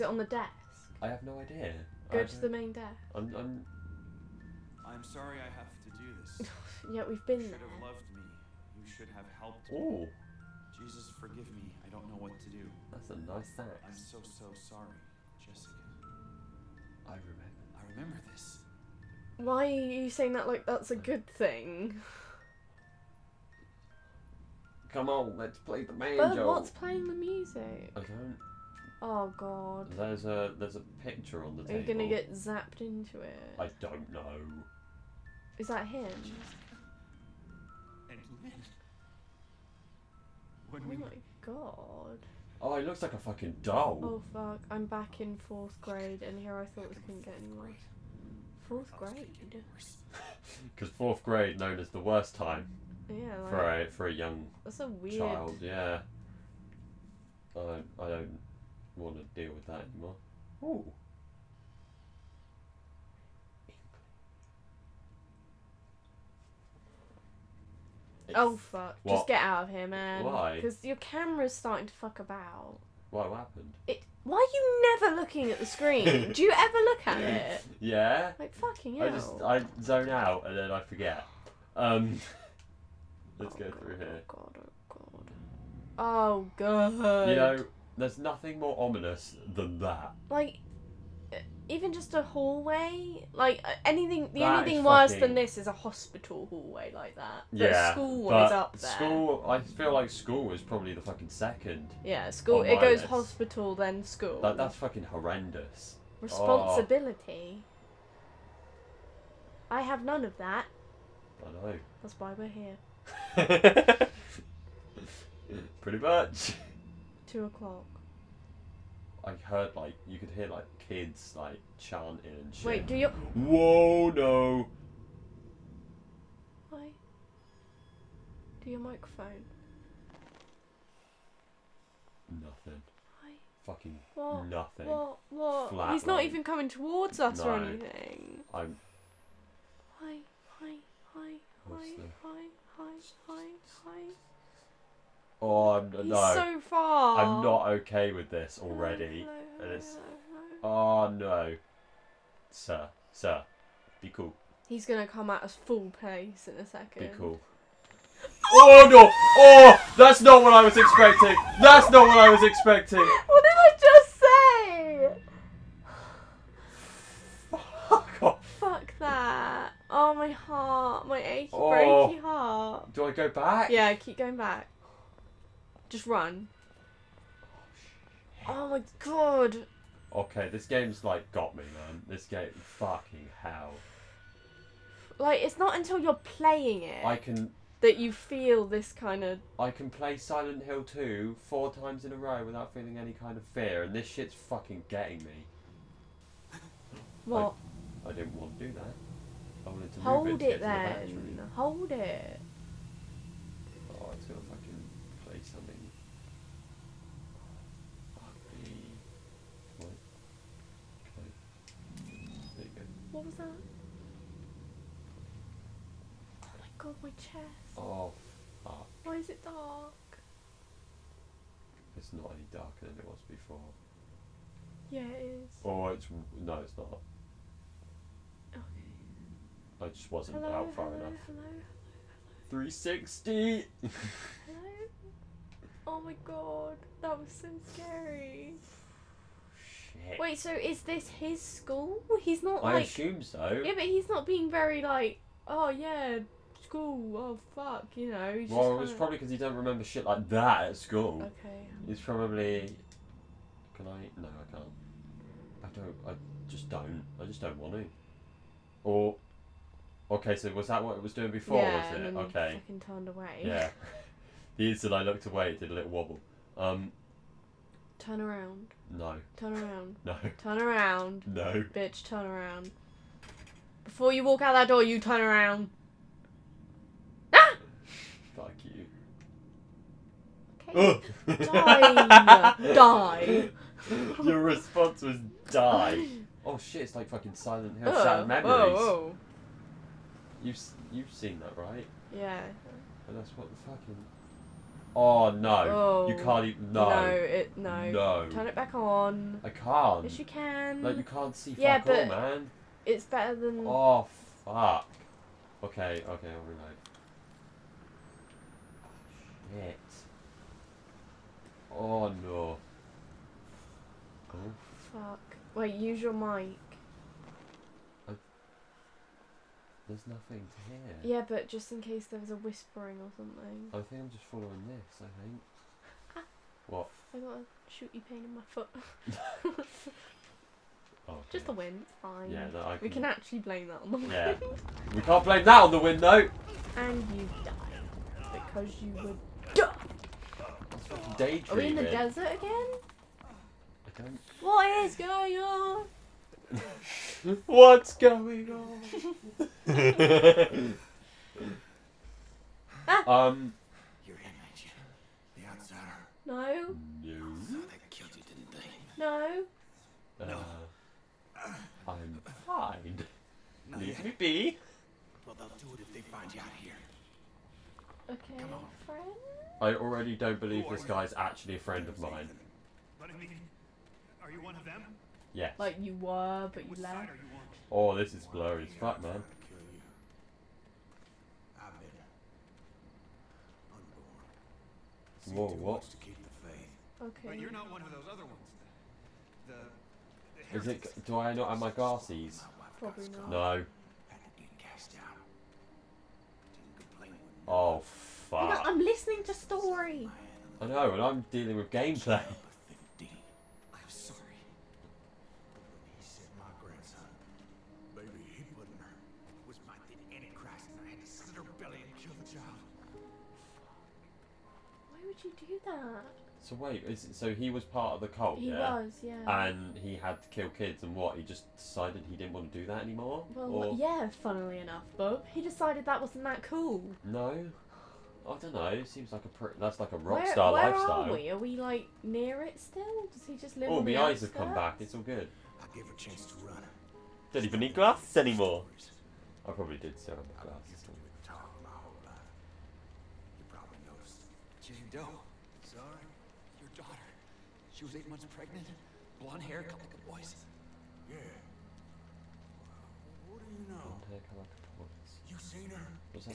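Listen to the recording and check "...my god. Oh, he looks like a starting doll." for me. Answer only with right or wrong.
wrong.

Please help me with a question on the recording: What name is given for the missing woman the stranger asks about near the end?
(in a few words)
Jane Doe.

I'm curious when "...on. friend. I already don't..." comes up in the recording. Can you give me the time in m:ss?
6:08.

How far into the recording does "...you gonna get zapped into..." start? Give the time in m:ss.
0:31.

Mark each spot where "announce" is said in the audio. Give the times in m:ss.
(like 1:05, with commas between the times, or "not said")
not said.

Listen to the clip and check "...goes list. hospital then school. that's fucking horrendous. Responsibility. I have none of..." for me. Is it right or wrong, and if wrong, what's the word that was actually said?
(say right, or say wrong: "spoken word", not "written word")
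right.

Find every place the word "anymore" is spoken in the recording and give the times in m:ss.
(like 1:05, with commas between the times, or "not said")
0:59, 7:02, 7:18.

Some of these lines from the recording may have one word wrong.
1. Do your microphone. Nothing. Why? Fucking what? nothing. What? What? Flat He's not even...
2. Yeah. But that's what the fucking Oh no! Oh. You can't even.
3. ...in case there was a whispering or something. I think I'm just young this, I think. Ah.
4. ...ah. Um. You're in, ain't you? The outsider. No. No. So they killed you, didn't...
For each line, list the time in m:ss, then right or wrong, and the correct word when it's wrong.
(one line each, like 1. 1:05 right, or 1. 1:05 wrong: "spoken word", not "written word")
1. 2:08 right
2. 4:52 right
3. 5:21 wrong: "following", not "young"
4. 5:52 right.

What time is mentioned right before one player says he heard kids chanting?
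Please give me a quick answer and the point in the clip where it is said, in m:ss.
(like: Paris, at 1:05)
two o'clock, at 1:57.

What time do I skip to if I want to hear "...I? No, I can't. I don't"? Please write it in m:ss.
4:13.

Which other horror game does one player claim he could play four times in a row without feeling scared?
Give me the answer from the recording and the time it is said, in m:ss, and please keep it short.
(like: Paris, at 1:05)
Silent Hill 2, at 3:10.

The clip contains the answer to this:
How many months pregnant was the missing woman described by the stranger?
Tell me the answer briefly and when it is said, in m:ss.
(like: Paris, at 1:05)
8, at 7:27.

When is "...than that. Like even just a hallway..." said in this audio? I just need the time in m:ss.
1:29.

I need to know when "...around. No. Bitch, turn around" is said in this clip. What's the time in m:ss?
4:30.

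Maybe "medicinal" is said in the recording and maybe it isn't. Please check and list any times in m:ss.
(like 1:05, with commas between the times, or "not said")
not said.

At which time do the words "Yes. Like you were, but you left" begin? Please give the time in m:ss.
6:15.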